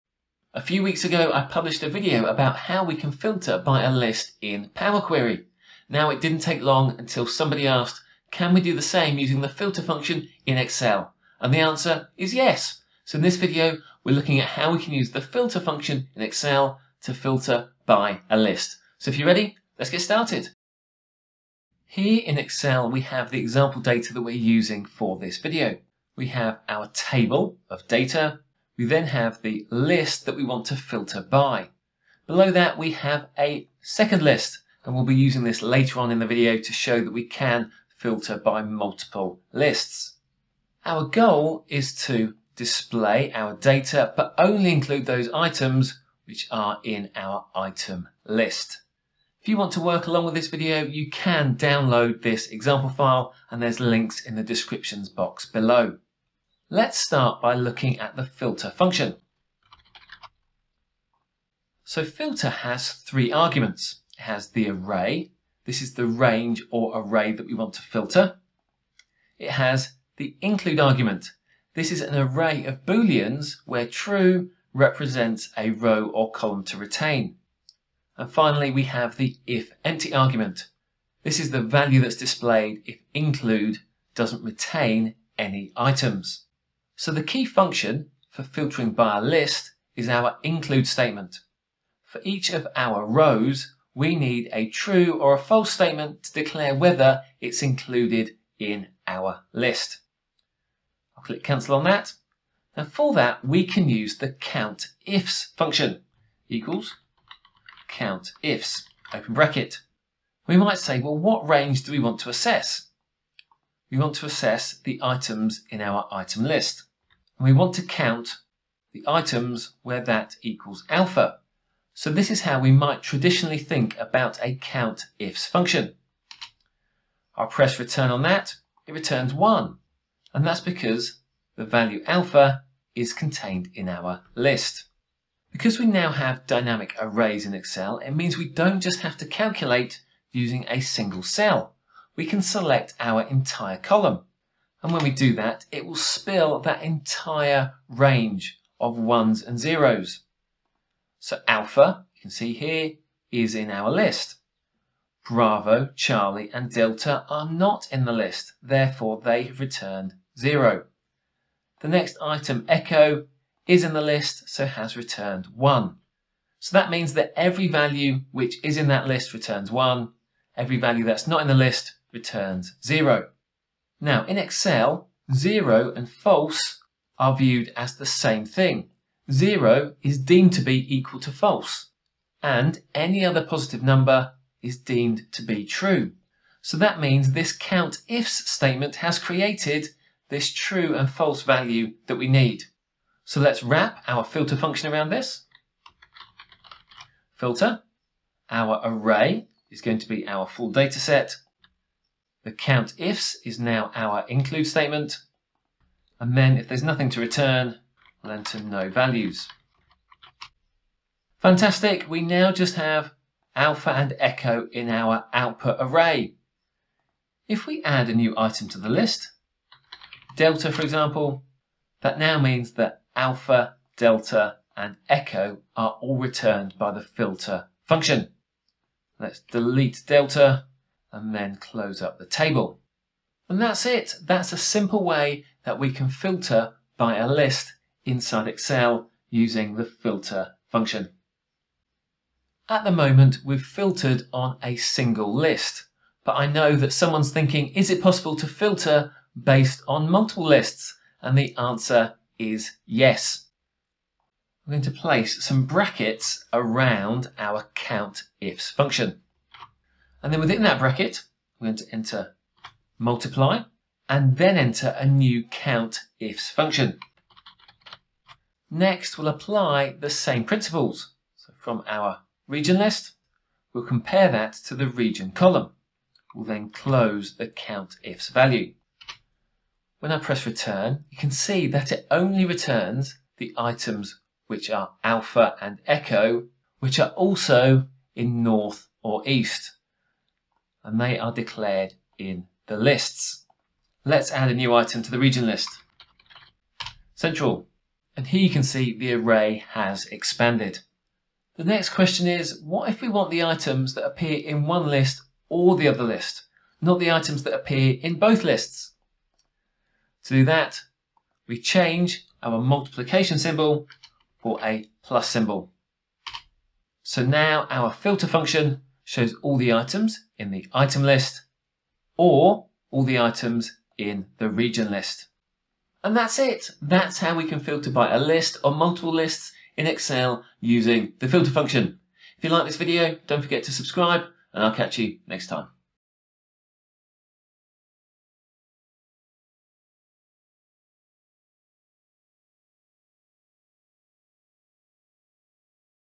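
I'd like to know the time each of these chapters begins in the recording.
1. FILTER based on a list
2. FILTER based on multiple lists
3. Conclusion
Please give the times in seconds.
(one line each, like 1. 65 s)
1. 25 s
2. 242 s
3. 324 s.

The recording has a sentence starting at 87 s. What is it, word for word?
So the key function for filtering by a list is our include statement.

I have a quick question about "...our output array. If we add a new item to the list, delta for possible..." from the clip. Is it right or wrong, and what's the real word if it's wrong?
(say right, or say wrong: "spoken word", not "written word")
wrong: "example", not "possible".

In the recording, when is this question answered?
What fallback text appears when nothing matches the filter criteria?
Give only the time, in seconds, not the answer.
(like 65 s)
208 s.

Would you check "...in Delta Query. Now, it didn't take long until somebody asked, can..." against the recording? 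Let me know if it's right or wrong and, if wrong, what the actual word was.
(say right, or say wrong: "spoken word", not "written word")
wrong: "Power", not "Delta".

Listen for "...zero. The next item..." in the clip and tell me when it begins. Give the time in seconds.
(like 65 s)
160 s.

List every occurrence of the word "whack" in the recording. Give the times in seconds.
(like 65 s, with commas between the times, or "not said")
not said.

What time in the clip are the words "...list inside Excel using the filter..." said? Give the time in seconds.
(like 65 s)
237 s.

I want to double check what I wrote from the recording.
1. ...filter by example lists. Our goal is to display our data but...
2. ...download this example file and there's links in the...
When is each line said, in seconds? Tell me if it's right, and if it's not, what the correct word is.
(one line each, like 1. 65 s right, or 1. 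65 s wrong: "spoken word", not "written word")
1. 37 s wrong: "multiple", not "example"
2. 51 s right.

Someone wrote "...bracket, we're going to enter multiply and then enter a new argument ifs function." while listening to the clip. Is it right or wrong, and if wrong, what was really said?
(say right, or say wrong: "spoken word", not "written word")
wrong: "count", not "argument".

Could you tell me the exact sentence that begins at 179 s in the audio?
Zero is deemed to be equal to false, and any other positive number is deemed to be true.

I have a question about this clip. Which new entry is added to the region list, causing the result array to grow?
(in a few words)
Central.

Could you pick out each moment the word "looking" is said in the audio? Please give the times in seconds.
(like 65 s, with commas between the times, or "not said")
14 s, 57 s.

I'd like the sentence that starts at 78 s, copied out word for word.
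And finally, we have the if empty argument.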